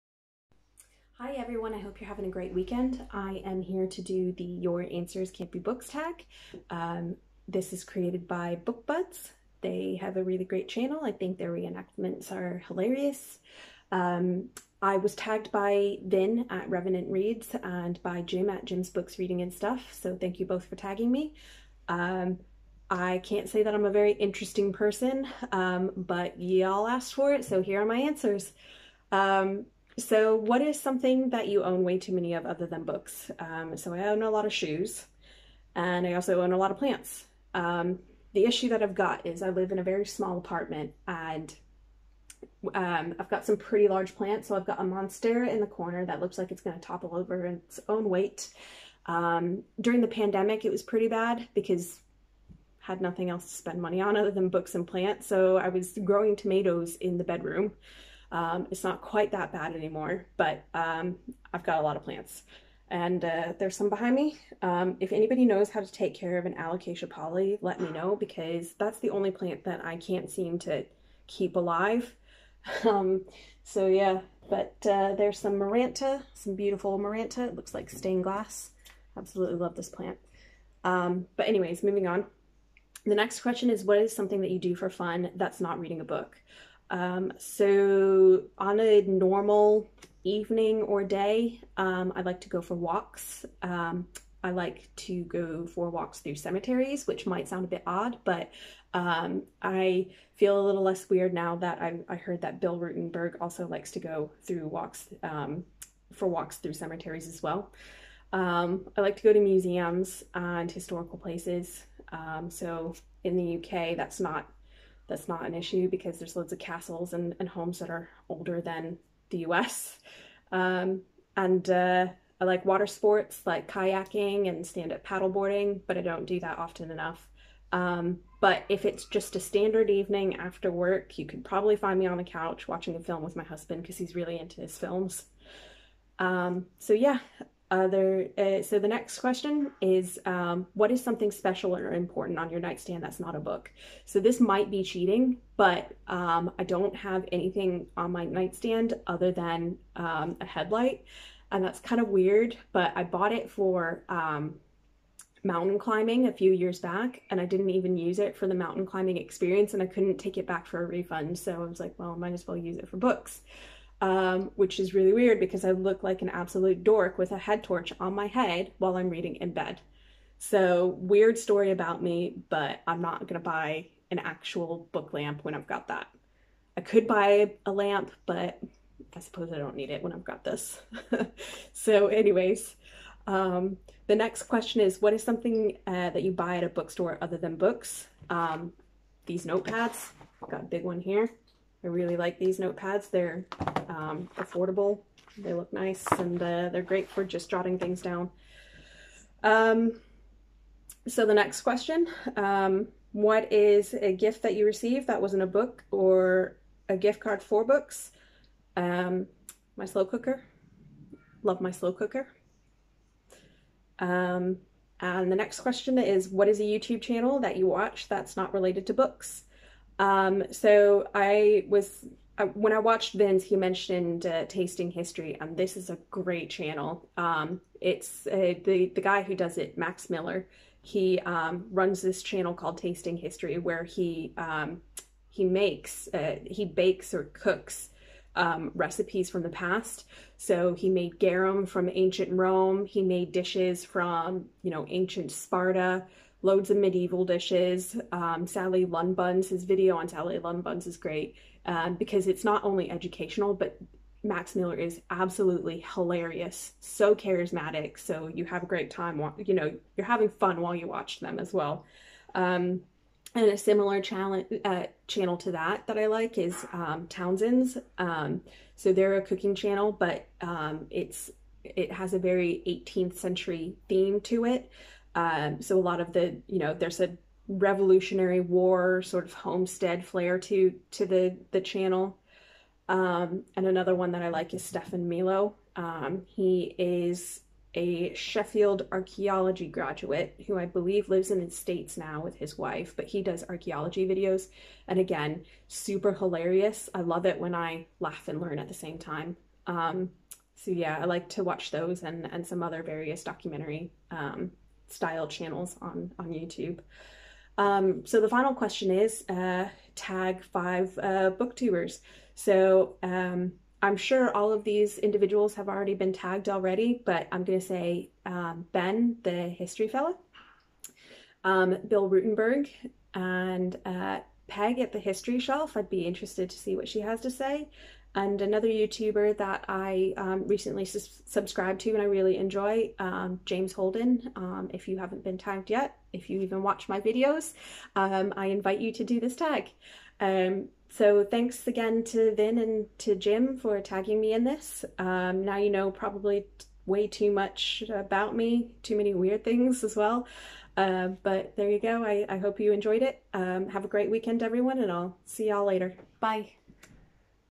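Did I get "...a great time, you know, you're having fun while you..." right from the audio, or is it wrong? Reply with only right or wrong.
right.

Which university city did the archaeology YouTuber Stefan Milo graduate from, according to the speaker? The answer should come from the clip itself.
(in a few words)
Sheffield.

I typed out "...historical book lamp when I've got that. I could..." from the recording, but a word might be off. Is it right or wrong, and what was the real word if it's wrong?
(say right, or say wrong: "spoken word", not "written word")
wrong: "actual", not "historical".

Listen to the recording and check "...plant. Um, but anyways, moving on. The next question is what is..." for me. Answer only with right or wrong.
right.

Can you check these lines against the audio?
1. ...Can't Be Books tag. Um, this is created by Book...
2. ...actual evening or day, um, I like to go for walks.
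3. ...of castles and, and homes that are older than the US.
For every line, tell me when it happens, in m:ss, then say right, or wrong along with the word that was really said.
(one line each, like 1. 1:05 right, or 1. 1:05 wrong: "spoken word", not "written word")
1. 0:05 right
2. 1:29 wrong: "normal", not "actual"
3. 1:56 right.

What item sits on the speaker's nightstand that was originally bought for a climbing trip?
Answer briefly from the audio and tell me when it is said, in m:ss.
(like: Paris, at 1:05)
Headlight, at 2:30.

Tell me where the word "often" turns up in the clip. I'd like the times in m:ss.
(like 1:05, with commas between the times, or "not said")
2:06.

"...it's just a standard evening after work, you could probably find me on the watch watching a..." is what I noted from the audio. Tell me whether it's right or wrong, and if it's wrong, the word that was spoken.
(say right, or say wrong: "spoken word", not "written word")
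wrong: "couch", not "watch".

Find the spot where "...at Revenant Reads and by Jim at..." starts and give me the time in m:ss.
0:16.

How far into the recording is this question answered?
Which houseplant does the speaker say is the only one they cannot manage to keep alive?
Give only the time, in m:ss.
1:06.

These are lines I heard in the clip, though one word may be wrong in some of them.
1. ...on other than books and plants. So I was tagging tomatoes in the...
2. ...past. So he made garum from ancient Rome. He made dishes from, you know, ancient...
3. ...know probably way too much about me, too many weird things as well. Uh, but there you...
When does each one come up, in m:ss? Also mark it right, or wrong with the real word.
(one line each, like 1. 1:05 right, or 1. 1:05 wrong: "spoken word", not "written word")
1. 0:54 wrong: "growing", not "tagging"
2. 3:59 right
3. 5:45 right.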